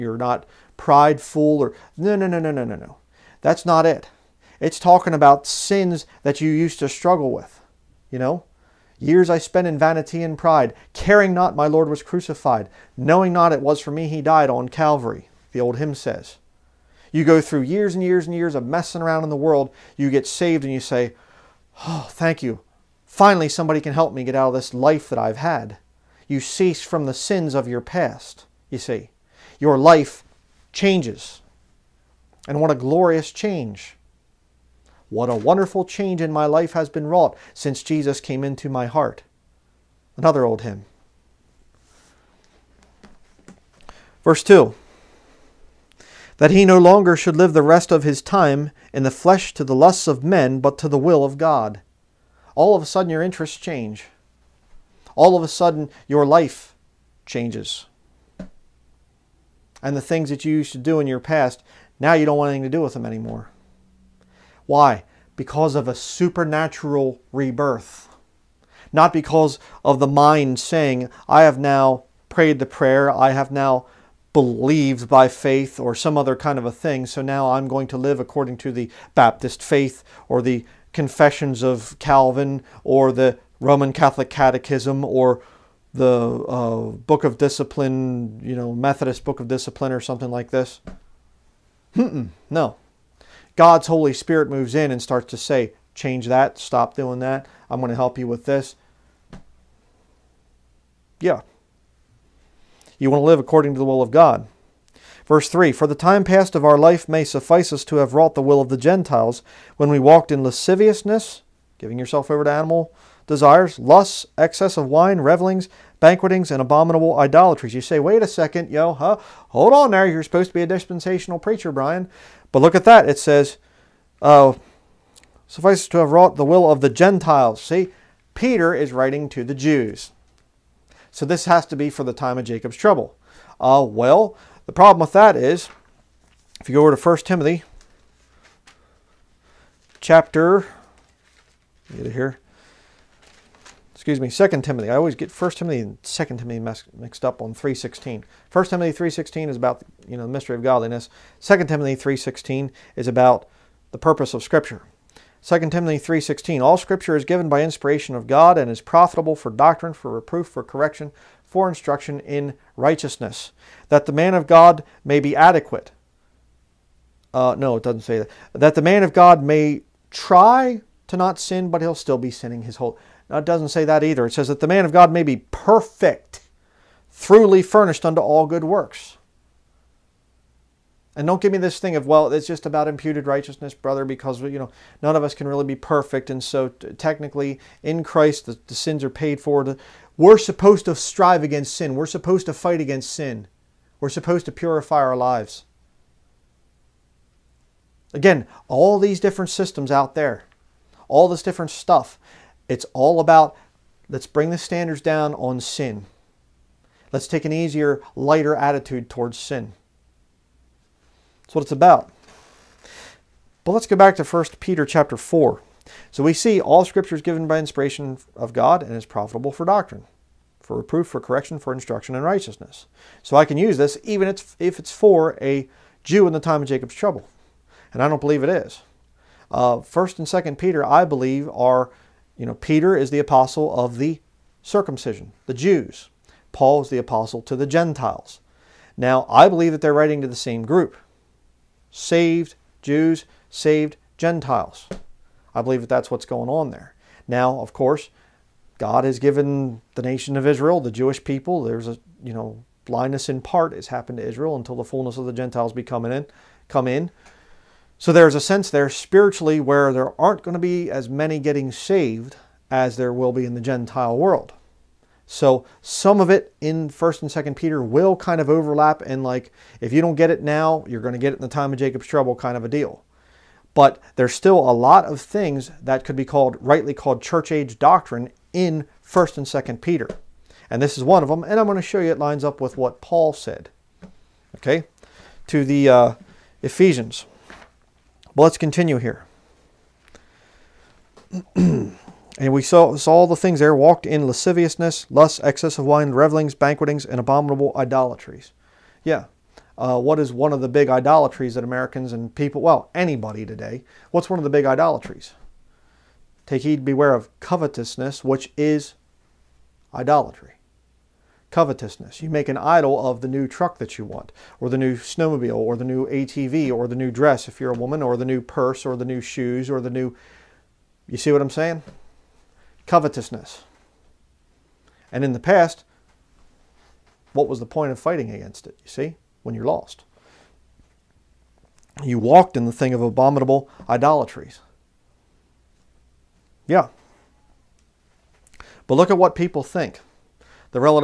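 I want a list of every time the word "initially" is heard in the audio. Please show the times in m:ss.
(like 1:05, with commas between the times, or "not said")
not said.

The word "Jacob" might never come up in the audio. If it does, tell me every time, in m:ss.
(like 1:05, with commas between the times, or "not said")
2:12, 3:46, 4:31.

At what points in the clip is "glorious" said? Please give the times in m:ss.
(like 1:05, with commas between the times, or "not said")
0:32.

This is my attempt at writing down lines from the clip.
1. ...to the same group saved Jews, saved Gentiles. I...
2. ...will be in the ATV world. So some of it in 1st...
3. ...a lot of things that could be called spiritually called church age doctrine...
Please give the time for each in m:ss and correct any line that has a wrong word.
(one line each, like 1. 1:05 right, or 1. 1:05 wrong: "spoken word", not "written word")
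1. 4:00 right
2. 4:23 wrong: "Gentile", not "ATV"
3. 4:34 wrong: "rightly", not "spiritually".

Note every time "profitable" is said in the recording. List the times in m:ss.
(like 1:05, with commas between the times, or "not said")
2:38, 3:39.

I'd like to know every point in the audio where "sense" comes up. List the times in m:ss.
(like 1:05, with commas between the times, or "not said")
4:18.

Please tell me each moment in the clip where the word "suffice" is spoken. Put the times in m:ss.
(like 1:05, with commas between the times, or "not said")
1:47, 2:05.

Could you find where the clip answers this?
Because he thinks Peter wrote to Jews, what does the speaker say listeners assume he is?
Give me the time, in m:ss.
2:00.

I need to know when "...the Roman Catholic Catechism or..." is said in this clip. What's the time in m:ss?
1:23.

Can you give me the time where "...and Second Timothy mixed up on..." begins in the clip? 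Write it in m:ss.
2:25.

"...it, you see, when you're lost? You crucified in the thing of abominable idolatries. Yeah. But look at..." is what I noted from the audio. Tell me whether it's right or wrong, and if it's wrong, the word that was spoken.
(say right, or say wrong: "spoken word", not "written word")
wrong: "walked", not "crucified".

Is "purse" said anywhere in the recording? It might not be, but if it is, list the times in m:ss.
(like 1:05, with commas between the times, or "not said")
5:18.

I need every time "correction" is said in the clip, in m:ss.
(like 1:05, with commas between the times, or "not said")
2:40, 3:41.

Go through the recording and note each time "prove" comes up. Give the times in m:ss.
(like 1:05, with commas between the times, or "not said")
not said.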